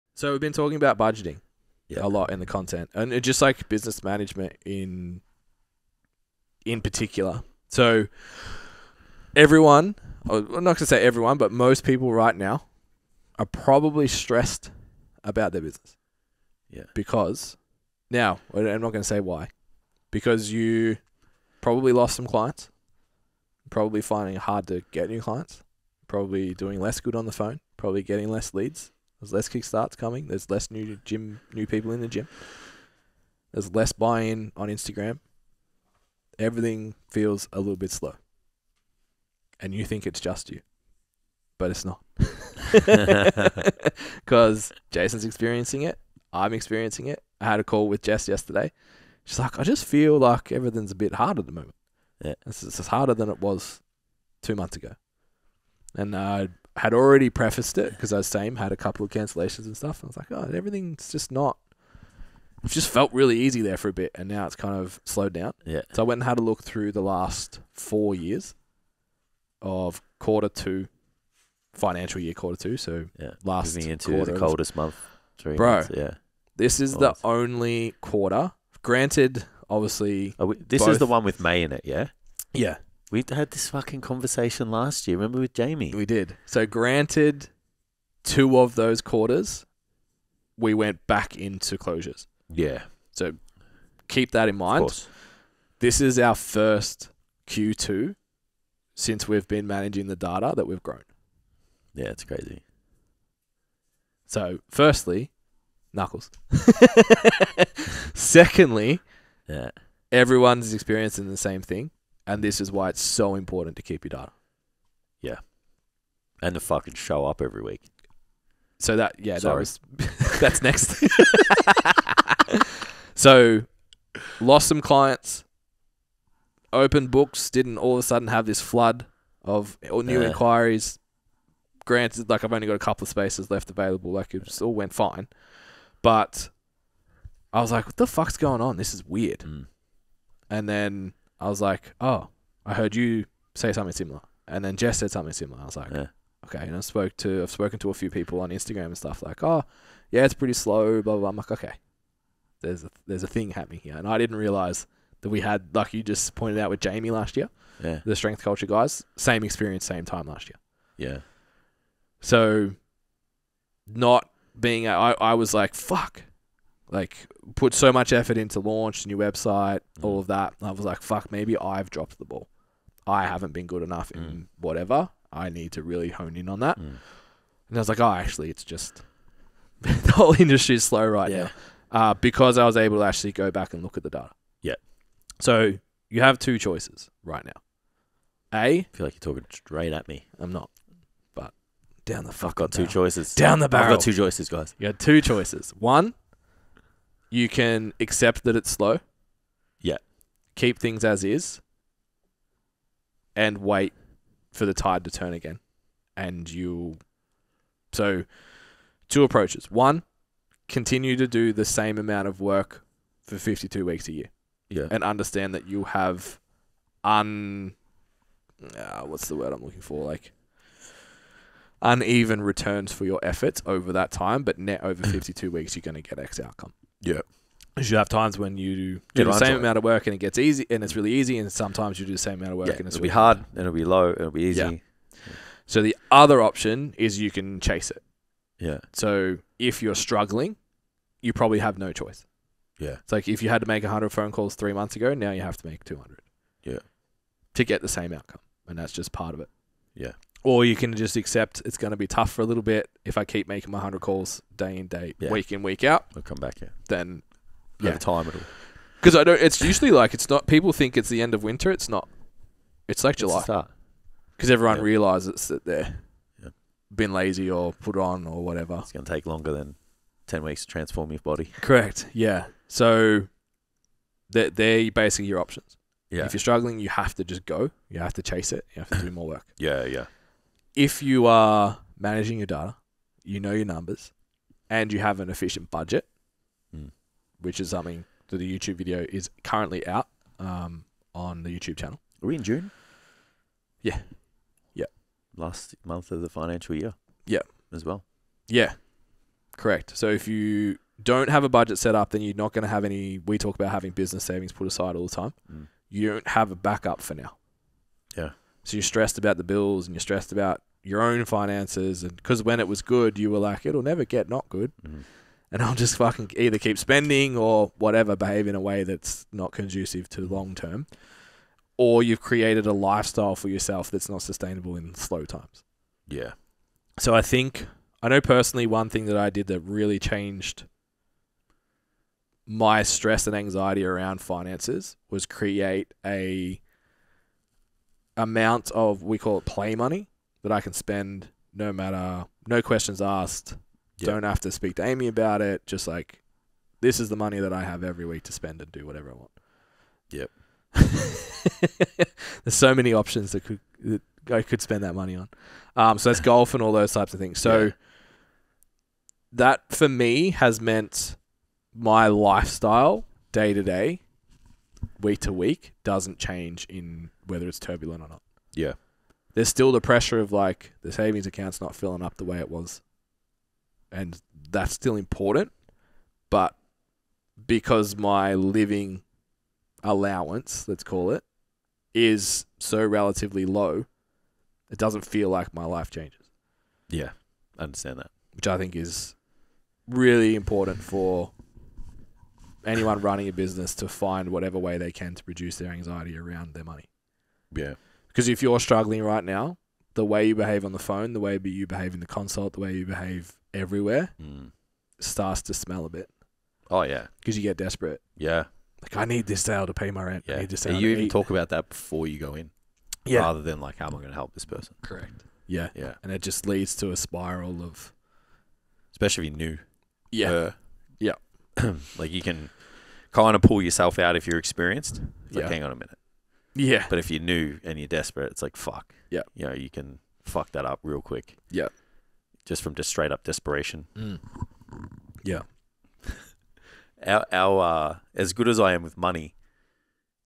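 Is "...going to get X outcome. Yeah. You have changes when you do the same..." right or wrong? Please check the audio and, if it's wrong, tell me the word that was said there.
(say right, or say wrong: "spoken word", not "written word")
wrong: "times", not "changes".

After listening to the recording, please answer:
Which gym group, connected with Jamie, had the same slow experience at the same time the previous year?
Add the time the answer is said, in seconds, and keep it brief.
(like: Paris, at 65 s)
the strength culture guys, at 158 s.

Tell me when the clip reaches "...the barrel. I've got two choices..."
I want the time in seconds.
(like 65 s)
193 s.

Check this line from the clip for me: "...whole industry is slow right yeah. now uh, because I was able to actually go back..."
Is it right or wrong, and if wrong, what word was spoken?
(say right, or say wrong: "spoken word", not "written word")
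right.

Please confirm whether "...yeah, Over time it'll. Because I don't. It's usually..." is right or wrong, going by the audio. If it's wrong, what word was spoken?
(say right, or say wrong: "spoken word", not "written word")
right.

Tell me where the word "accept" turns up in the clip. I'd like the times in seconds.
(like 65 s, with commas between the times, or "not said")
197 s, 251 s.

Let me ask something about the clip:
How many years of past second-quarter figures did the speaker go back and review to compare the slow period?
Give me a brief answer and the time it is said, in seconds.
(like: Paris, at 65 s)
4, at 67 s.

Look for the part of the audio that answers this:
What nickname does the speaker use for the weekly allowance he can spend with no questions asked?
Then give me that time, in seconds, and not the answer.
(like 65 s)
339 s.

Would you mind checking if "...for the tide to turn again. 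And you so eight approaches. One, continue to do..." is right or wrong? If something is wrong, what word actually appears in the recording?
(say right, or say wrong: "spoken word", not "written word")
wrong: "two", not "eight".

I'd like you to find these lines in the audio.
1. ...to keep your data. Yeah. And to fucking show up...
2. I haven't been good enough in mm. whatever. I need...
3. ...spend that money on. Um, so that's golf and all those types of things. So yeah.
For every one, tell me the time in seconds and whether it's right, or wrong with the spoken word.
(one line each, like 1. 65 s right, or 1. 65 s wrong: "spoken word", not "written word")
1. 113 s right
2. 173 s right
3. 354 s right.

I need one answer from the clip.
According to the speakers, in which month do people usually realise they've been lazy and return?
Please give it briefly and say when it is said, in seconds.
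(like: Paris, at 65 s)
July, at 263 s.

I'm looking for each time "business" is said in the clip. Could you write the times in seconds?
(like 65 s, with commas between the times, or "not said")
3 s, 15 s, 303 s, 393 s.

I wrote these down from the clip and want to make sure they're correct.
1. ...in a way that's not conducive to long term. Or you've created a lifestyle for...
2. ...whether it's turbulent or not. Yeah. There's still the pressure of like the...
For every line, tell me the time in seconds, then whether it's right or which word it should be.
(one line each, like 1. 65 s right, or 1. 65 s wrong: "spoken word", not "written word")
1. 318 s right
2. 367 s right.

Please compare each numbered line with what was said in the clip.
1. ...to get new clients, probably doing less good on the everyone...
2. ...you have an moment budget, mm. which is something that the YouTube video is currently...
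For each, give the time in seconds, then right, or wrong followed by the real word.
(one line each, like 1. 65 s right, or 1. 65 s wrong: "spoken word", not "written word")
1. 24 s wrong: "phone", not "everyone"
2. 284 s wrong: "efficient", not "moment".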